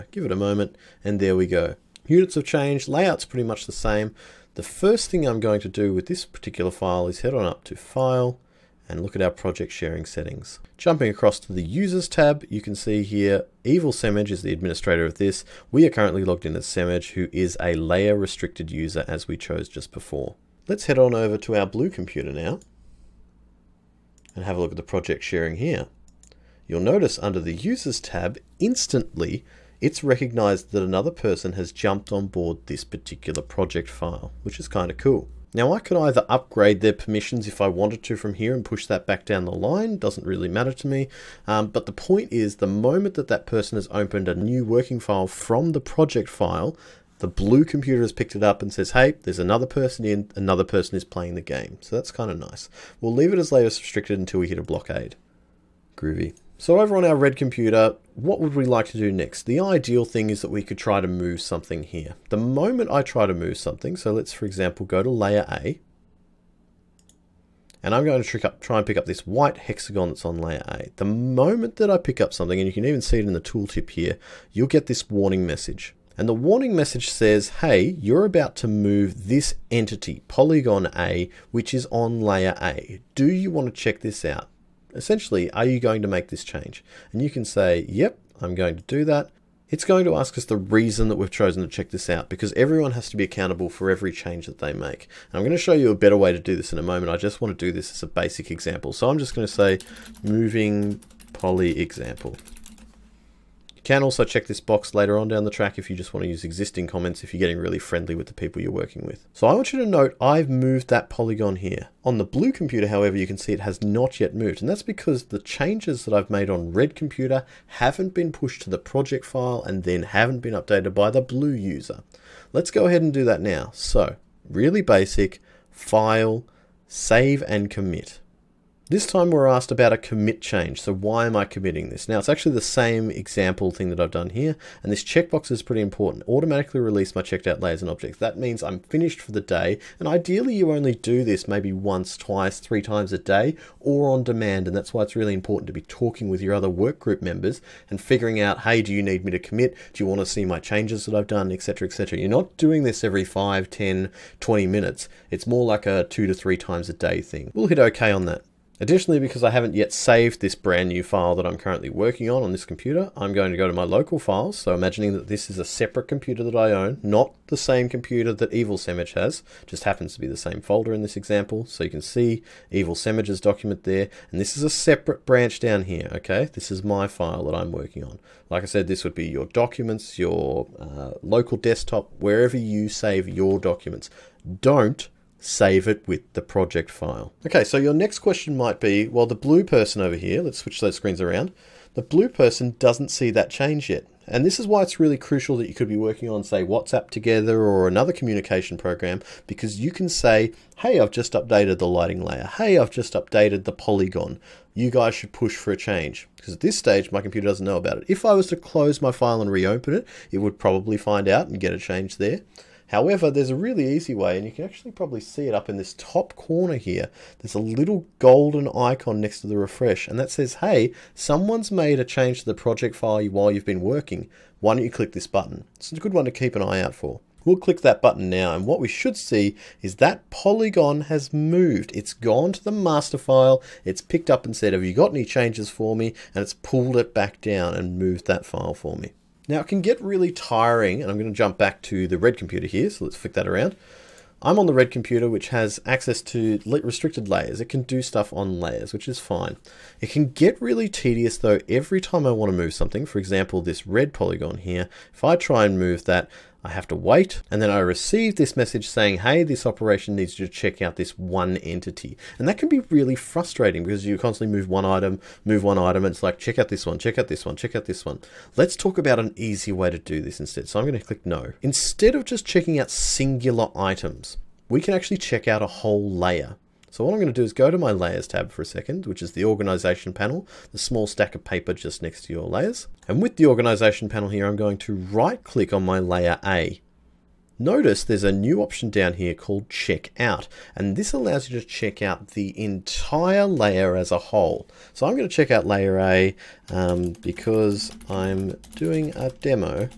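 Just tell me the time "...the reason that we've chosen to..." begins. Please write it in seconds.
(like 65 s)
90 s.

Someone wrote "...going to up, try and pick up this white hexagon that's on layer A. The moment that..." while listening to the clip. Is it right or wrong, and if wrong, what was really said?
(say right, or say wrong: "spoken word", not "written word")
right.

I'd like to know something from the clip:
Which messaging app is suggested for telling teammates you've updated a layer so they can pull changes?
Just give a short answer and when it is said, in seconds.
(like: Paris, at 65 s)
WhatsApp, at 196 s.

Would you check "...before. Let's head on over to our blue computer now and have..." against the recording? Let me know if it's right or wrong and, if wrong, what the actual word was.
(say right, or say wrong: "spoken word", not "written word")
right.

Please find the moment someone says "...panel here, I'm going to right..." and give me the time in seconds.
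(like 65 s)
284 s.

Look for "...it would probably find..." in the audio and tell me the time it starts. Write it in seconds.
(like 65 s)
210 s.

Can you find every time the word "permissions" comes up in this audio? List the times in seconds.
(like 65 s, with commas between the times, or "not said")
36 s.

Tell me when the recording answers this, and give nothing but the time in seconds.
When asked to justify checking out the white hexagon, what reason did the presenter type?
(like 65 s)
100 s.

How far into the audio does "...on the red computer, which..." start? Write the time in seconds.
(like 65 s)
244 s.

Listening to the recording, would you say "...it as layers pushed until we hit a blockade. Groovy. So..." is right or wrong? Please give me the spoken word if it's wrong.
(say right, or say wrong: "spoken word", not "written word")
wrong: "restricted", not "pushed".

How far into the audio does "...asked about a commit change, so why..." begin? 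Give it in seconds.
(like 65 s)
129 s.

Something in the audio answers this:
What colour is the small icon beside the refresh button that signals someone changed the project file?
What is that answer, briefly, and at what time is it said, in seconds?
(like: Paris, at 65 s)
Golden, at 218 s.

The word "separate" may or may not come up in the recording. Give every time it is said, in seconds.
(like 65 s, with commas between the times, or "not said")
165 s, 174 s.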